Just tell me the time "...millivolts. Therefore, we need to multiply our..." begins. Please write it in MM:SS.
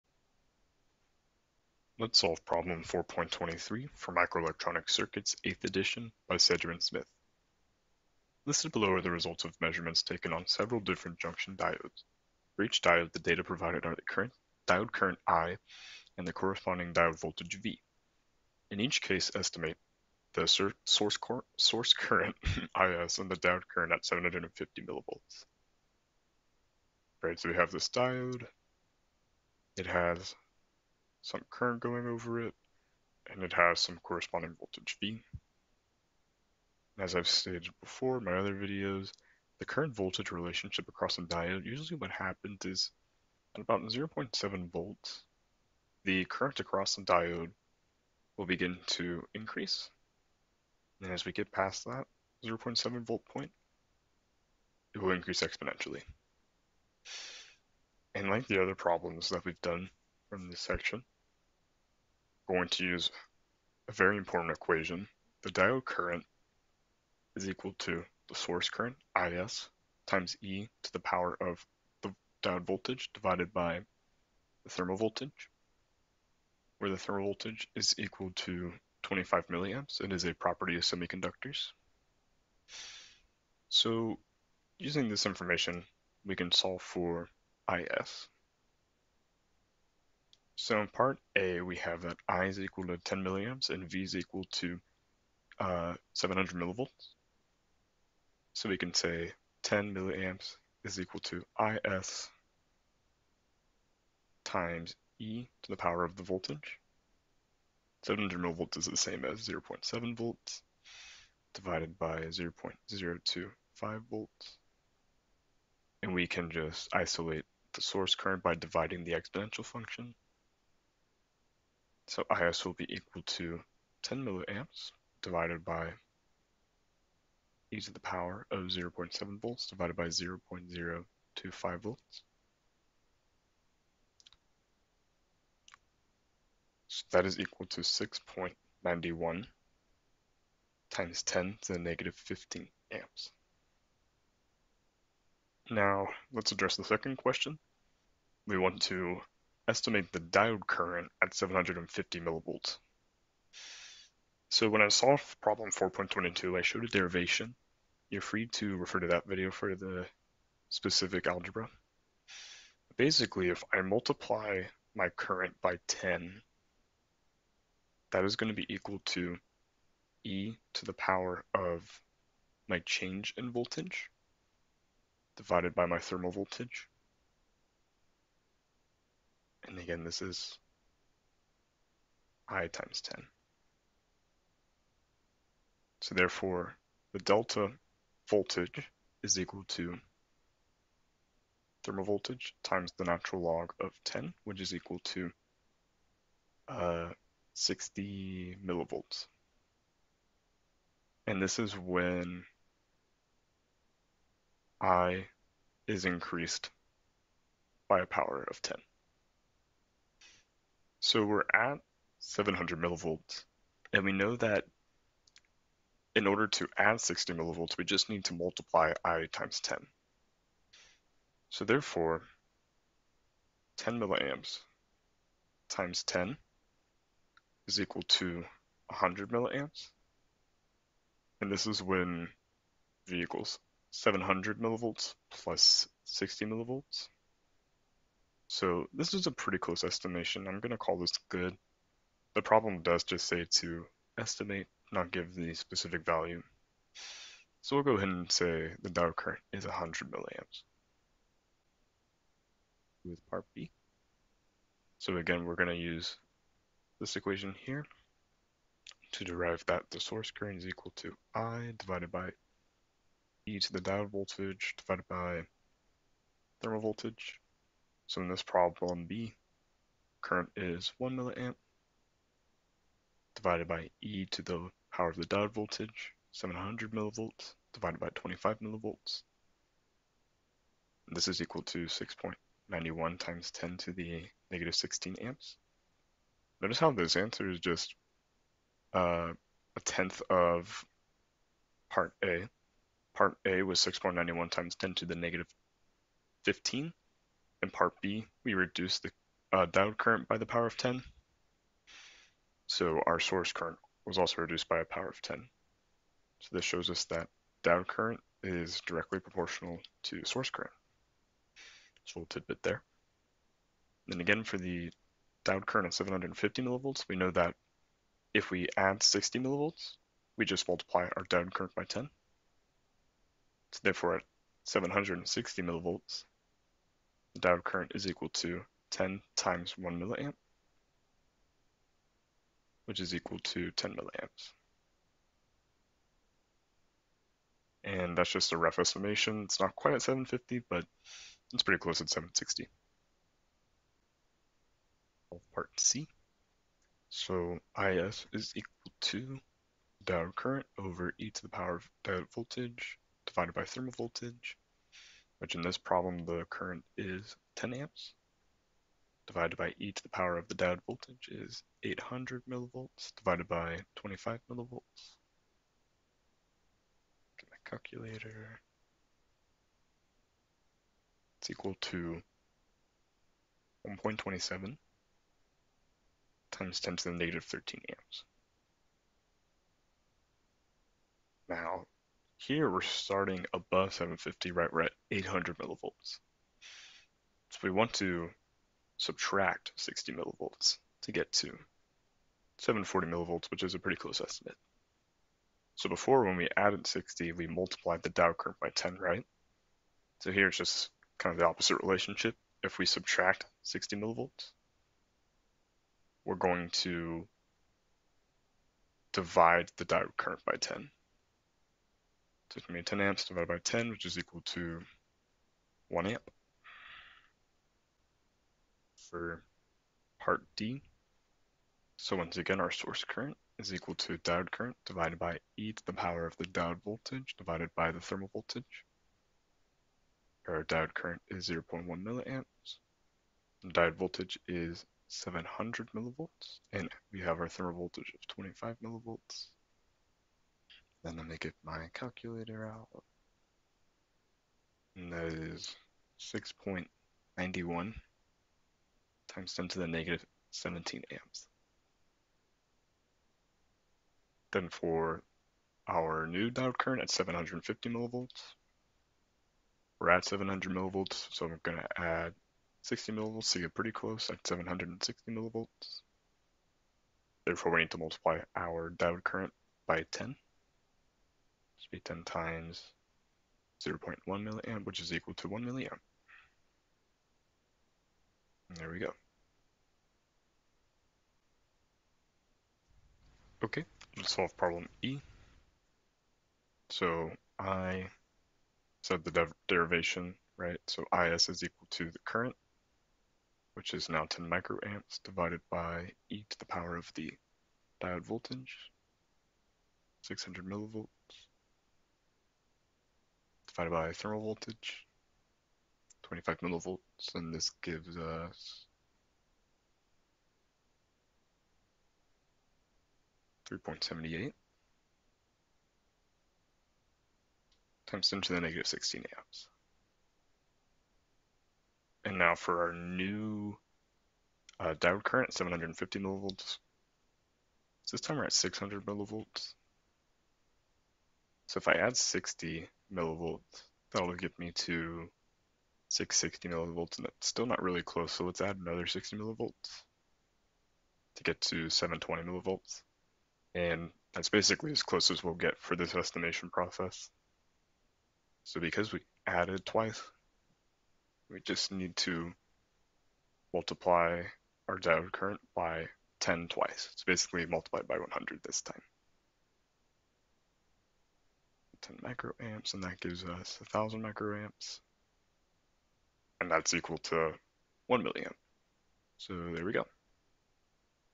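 07:45.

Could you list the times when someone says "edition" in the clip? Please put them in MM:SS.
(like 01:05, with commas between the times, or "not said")
00:05.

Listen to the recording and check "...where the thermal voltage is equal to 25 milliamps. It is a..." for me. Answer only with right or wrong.
right.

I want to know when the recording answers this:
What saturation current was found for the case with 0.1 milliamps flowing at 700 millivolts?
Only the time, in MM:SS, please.
07:26.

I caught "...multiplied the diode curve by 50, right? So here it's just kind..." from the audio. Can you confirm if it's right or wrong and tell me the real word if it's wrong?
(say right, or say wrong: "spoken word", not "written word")
wrong: "10", not "50".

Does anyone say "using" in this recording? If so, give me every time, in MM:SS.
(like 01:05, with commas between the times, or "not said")
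01:24.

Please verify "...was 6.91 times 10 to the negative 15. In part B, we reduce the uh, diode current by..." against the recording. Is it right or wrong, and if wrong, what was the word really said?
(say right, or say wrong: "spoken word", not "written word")
right.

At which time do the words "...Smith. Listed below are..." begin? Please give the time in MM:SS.
00:06.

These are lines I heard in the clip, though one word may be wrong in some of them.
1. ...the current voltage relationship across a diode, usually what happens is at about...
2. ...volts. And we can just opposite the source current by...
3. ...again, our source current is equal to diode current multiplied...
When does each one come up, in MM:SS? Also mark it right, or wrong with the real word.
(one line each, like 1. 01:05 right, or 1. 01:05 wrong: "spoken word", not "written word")
1. 00:39 right
2. 01:54 wrong: "isolate", not "opposite"
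3. 07:02 wrong: "divided", not "multiplied".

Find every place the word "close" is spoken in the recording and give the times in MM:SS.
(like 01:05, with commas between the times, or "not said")
03:59, 05:41, 06:33, 07:43, 08:58, 09:05.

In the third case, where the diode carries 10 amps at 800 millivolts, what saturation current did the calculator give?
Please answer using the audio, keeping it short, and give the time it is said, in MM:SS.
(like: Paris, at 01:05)
1.27 × 10^-13 A, at 06:13.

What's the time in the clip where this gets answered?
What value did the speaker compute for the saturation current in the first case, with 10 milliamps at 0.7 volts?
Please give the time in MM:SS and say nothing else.
02:17.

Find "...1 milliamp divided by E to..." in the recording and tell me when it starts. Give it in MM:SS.
04:30.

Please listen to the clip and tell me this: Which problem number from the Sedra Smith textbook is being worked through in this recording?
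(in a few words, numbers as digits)
4.23.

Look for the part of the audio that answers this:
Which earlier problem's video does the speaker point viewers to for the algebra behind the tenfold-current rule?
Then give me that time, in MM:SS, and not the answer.
02:35.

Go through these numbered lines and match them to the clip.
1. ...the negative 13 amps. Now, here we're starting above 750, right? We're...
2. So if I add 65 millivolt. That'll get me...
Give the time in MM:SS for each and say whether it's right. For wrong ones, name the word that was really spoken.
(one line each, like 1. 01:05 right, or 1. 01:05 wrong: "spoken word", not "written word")
1. 06:17 right
2. 08:51 wrong: "60", not "65".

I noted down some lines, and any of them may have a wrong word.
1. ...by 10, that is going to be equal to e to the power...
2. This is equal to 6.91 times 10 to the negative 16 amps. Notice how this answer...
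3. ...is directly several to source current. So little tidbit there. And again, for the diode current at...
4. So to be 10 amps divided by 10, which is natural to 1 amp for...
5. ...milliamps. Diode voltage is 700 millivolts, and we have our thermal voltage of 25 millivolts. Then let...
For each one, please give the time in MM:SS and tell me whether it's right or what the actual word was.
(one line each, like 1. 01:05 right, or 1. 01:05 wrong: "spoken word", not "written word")
1. 02:45 right
2. 04:41 right
3. 05:08 wrong: "proportional", not "several"
4. 06:52 wrong: "equal", not "natural"
5. 07:11 right.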